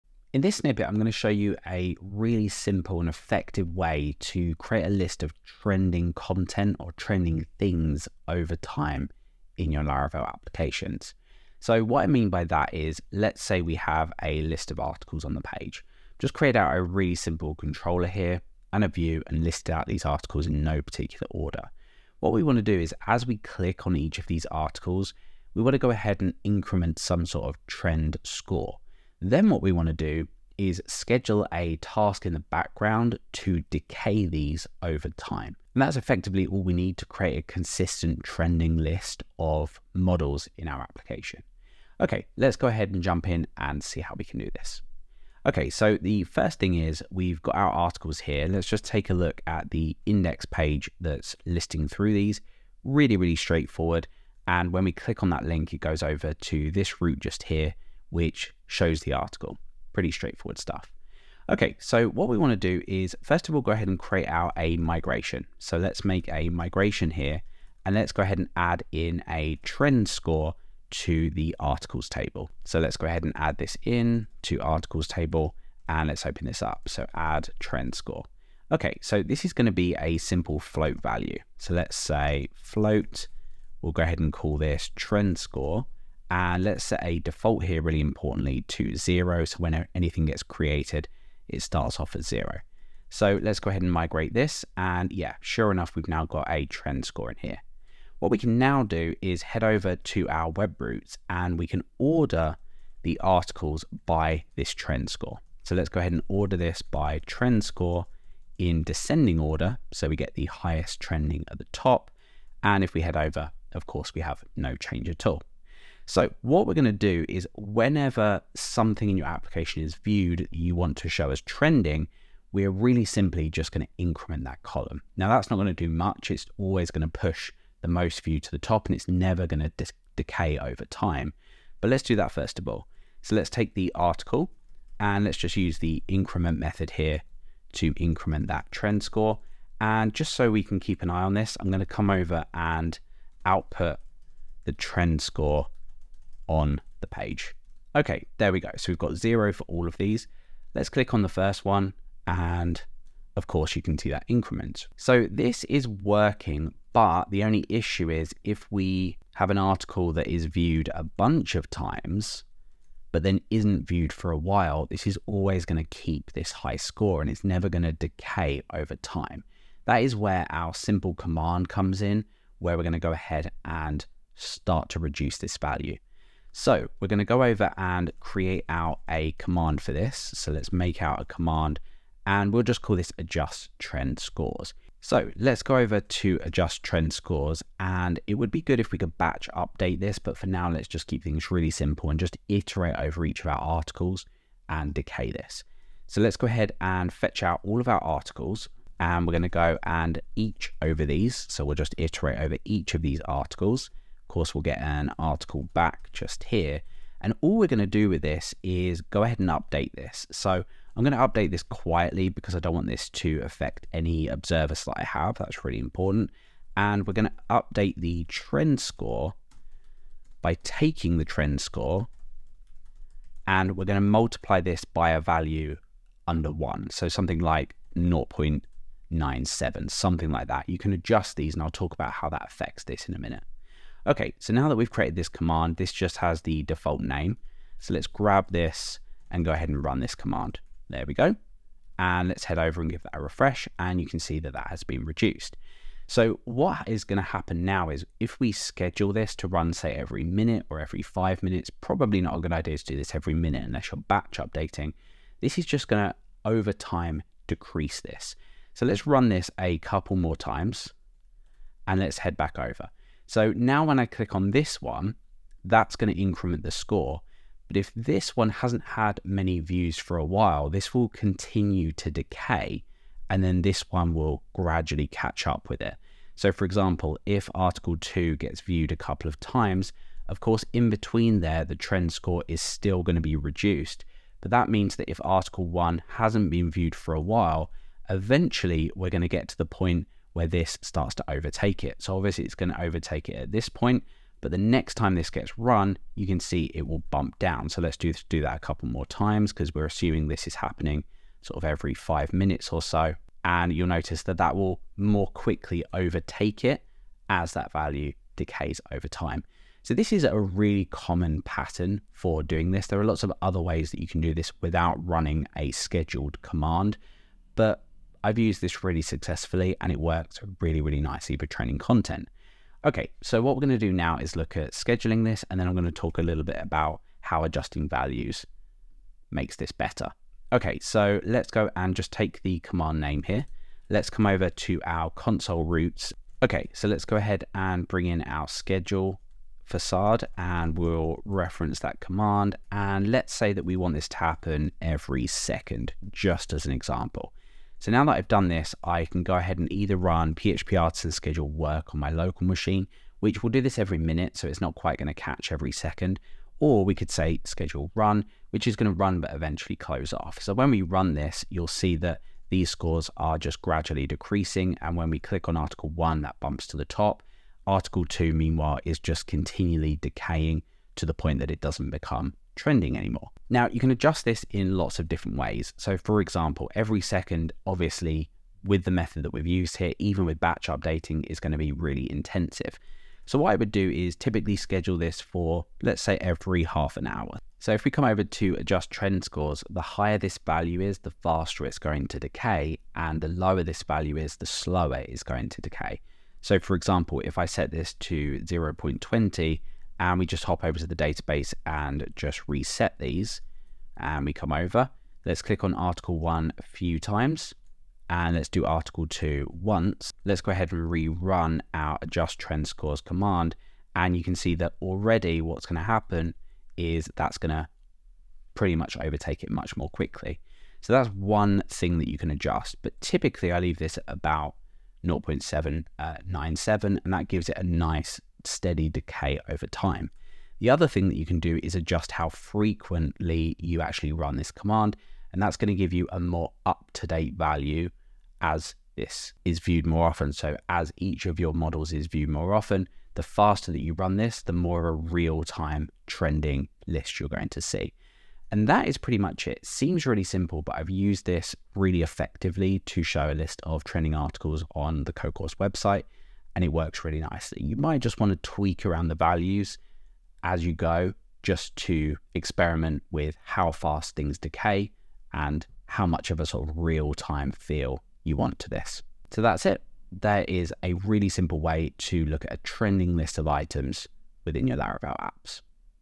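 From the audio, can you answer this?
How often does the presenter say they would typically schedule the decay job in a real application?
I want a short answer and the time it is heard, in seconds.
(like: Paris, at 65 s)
every half an hour, at 386 s.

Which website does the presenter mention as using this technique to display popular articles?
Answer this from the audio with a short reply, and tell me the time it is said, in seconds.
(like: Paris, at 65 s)
Codecourse, at 455 s.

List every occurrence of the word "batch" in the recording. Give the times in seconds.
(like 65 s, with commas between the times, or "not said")
189 s, 254 s, 380 s.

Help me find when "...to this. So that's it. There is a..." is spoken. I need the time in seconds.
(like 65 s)
468 s.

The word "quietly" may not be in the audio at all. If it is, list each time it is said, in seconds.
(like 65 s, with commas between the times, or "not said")
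211 s.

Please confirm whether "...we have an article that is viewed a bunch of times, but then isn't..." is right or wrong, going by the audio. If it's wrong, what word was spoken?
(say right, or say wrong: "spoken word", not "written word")
right.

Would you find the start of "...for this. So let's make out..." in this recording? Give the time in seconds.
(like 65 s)
179 s.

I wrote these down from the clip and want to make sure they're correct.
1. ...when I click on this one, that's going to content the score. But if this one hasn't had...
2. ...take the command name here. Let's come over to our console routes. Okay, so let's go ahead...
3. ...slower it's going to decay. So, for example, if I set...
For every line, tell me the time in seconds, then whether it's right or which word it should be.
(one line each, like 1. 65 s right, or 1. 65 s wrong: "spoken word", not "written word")
1. 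263 s wrong: "increment", not "content"
2. 332 s right
3. 394 s right.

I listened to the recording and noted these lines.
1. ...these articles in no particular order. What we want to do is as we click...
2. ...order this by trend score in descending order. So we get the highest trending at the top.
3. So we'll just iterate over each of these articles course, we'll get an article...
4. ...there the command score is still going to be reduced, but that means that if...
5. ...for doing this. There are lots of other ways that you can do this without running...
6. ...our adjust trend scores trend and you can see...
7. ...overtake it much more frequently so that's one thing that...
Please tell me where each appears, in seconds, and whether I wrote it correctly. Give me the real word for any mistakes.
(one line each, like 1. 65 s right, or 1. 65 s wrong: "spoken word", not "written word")
1. 19 s right
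2. 106 s right
3. 201 s right
4. 281 s wrong: "trend", not "command"
5. 312 s right
6. 411 s wrong: "command", not "trend"
7. 419 s wrong: "quickly", not "frequently".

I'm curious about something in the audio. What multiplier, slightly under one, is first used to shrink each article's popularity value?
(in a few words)
0.97.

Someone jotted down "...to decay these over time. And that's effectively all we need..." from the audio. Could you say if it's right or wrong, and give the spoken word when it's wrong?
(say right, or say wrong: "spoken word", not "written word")
right.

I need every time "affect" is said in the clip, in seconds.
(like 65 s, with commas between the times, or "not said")
213 s, 232 s.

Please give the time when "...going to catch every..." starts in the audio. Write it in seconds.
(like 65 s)
354 s.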